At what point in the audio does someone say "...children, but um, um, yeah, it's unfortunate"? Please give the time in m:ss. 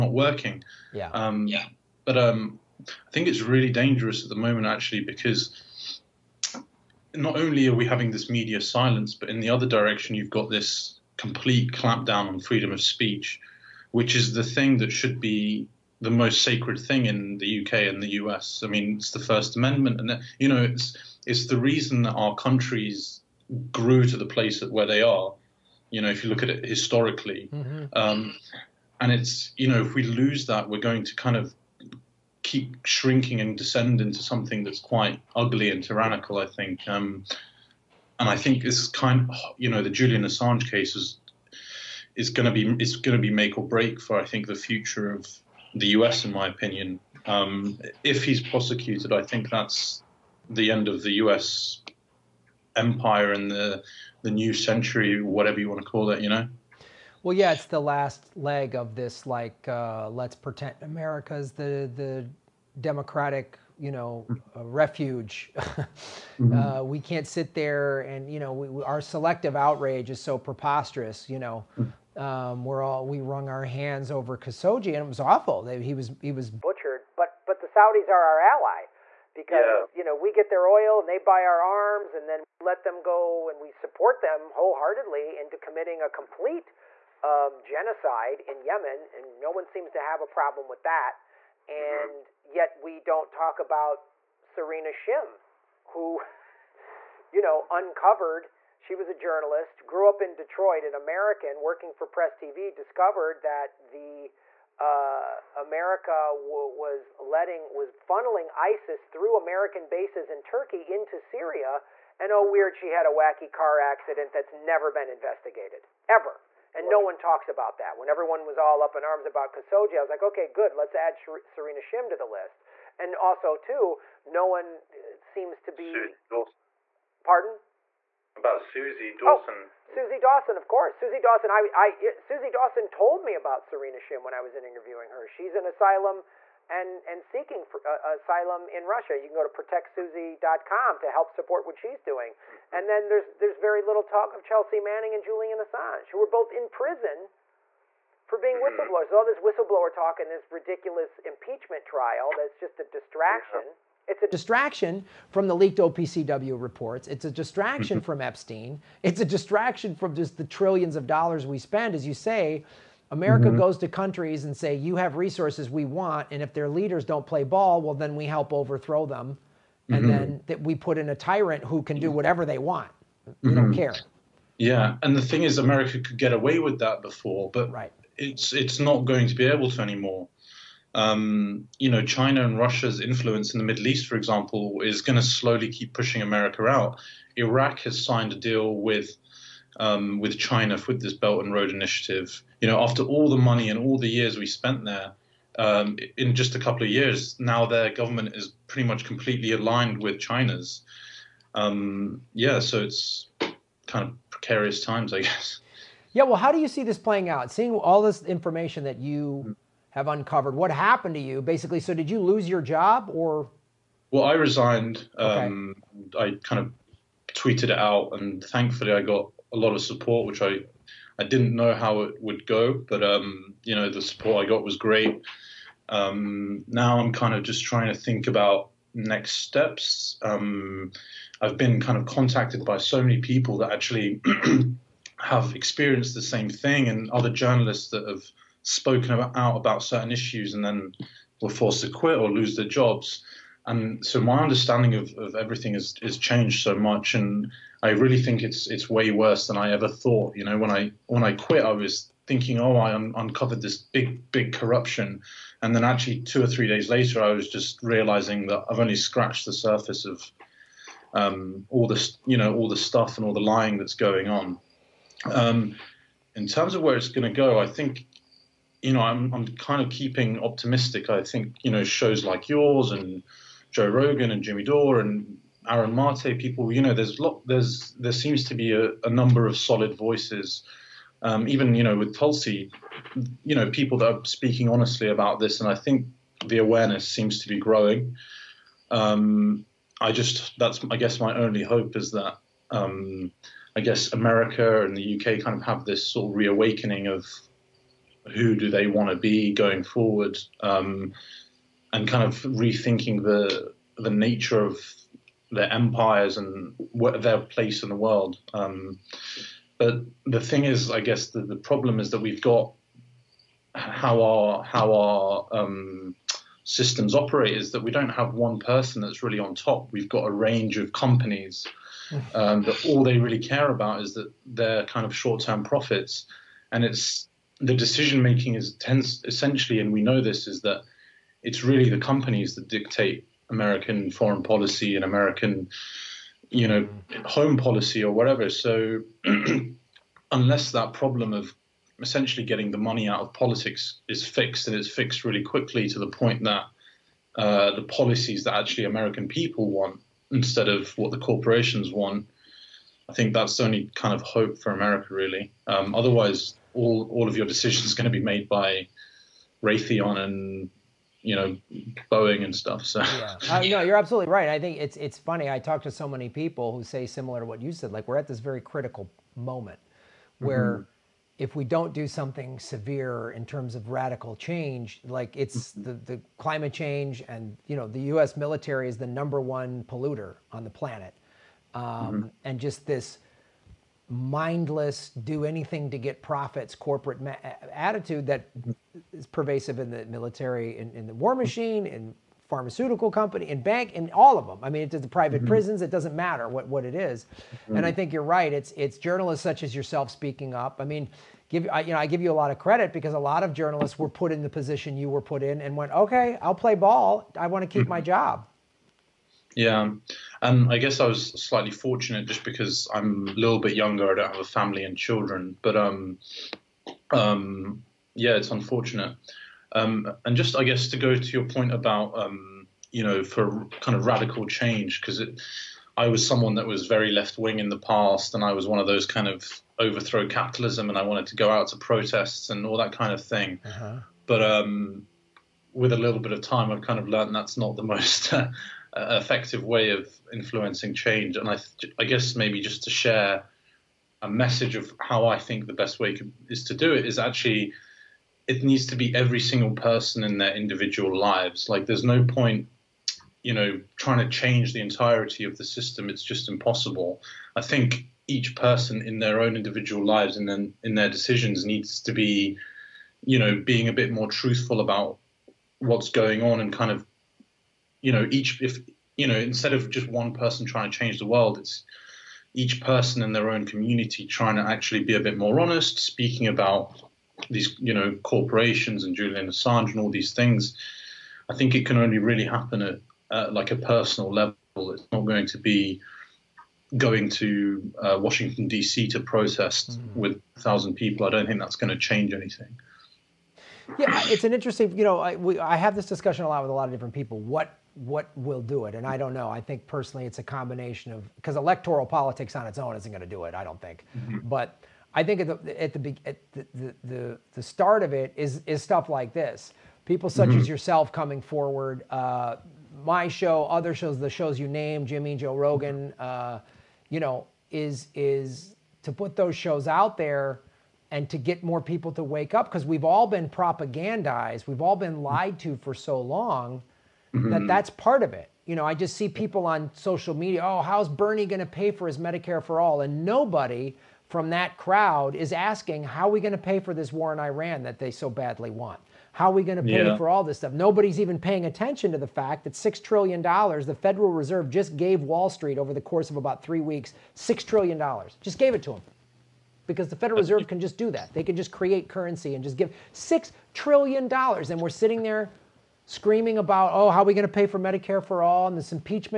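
6:54.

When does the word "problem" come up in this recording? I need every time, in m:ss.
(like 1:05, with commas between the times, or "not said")
1:30, 5:11, 5:40.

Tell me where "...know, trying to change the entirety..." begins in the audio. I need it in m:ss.
7:33.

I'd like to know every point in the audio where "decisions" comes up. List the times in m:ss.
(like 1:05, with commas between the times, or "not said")
5:27, 5:57, 7:41.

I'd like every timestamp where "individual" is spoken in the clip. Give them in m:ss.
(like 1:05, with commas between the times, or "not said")
7:30, 7:39.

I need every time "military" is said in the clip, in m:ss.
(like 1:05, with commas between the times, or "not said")
6:18, 6:30.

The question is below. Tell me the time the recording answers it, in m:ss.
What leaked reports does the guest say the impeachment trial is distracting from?
2:35.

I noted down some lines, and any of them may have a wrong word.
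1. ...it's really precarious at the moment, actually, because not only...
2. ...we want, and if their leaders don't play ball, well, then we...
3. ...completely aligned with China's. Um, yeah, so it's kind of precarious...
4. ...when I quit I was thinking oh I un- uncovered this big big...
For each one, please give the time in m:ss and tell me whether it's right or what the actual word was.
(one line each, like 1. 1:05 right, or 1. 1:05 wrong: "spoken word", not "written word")
1. 0:03 wrong: "dangerous", not "precarious"
2. 2:45 right
3. 3:19 right
4. 4:11 right.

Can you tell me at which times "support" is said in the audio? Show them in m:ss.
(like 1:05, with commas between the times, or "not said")
1:23, 2:21, 3:39, 3:44.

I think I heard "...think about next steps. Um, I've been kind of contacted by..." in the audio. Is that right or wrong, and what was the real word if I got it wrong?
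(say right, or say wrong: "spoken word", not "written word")
right.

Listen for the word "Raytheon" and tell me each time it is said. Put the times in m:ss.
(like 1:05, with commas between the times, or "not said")
5:59.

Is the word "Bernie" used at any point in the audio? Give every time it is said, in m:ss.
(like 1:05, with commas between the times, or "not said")
8:51.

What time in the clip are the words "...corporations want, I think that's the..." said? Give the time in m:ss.
5:51.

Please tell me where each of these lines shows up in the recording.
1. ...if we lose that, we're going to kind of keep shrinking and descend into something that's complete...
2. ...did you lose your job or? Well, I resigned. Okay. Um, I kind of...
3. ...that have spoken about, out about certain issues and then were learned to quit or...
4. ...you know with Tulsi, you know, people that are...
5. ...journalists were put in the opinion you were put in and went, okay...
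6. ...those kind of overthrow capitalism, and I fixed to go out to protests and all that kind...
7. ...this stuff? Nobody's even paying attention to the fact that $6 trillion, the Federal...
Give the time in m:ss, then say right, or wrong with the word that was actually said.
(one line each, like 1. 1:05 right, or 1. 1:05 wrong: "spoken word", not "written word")
1. 0:29 wrong: "quite", not "complete"
2. 3:31 right
3. 3:57 wrong: "forced", not "learned"
4. 4:41 right
5. 6:43 wrong: "position", not "opinion"
6. 7:08 wrong: "wanted", not "fixed"
7. 9:00 right.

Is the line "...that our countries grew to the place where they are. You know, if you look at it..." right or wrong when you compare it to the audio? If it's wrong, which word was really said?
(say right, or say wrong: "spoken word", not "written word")
right.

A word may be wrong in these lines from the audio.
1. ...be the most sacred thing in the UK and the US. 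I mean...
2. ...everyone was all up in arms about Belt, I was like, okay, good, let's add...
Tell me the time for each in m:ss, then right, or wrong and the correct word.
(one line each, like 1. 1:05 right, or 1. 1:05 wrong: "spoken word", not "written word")
1. 0:15 right
2. 1:58 wrong: "Khashoggi", not "Belt".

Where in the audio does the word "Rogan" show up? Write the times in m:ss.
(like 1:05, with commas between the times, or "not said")
4:33, 8:35.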